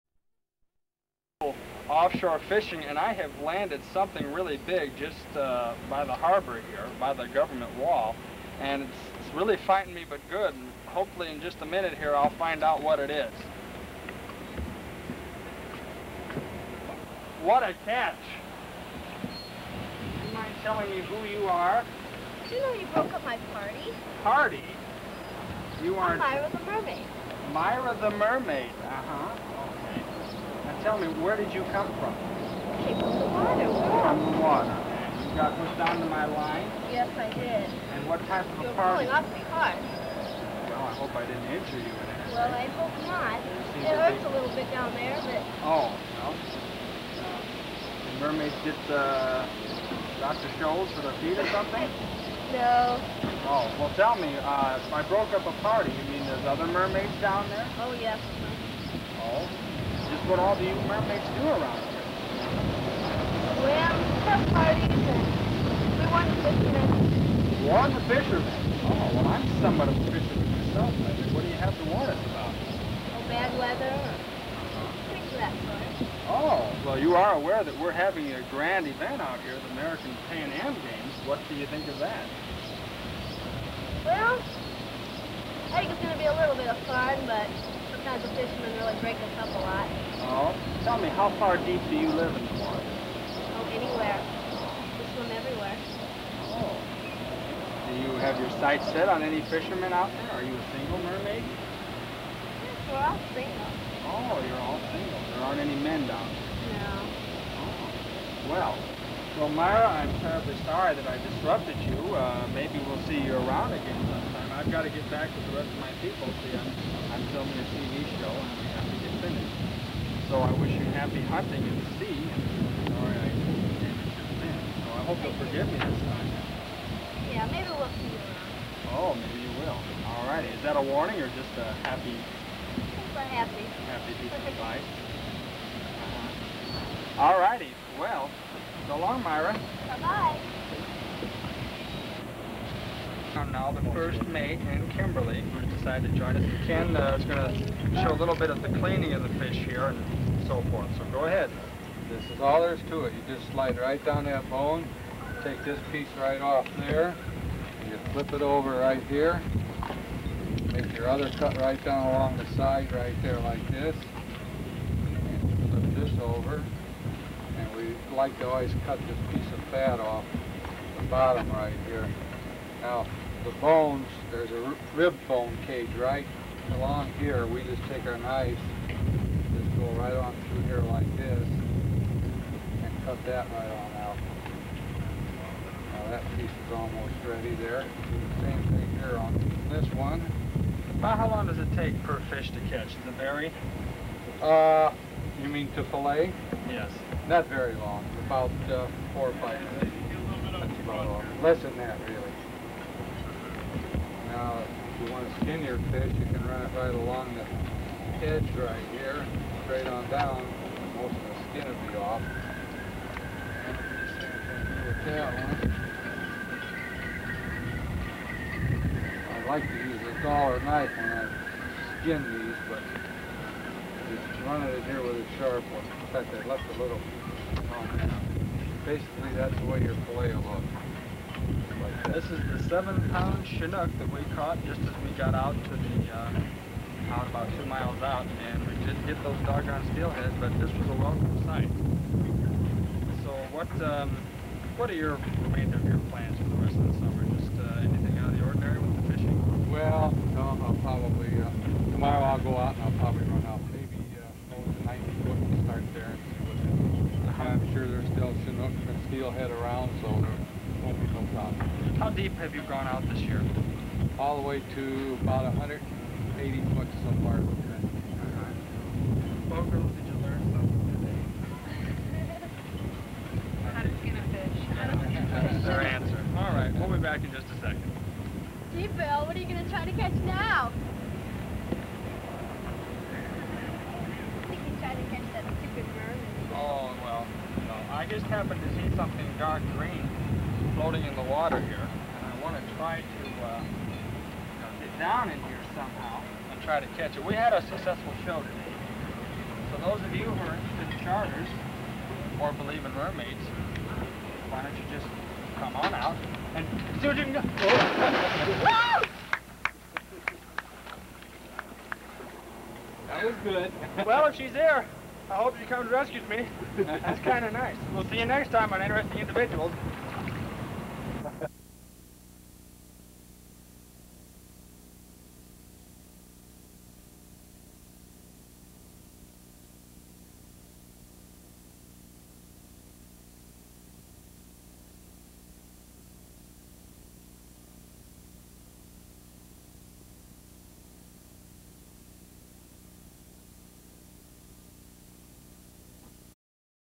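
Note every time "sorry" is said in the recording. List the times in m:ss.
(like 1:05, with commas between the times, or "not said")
1:50, 2:02.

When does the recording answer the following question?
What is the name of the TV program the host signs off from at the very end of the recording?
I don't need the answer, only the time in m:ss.
5:18.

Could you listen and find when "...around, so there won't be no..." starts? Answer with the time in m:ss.
4:19.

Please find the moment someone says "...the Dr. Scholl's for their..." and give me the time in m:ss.
0:48.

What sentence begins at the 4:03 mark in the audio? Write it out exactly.
So what, um, what are your remainder of your plans for the rest of the summer?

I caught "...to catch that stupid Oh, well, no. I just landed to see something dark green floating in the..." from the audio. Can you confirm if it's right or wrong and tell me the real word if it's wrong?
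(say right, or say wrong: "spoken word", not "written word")
wrong: "happened", not "landed".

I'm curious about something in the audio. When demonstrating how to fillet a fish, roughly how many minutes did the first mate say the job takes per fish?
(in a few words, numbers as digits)
4 or 5 minutes.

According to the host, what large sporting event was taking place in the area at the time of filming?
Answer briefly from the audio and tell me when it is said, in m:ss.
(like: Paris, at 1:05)
the American Pan Am Games, at 1:19.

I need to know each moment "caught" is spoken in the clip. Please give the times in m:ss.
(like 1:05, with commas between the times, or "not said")
3:54.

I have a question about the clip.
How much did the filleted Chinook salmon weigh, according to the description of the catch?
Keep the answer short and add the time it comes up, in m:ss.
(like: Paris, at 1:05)
7 pounds, at 3:52.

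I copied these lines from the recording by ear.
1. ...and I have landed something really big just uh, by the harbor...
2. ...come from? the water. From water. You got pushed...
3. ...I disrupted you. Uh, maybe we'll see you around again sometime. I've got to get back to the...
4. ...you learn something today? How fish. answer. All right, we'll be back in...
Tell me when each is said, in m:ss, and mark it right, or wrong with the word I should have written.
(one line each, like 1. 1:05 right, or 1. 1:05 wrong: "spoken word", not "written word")
1. 0:02 right
2. 0:31 right
3. 1:51 right
4. 4:30 right.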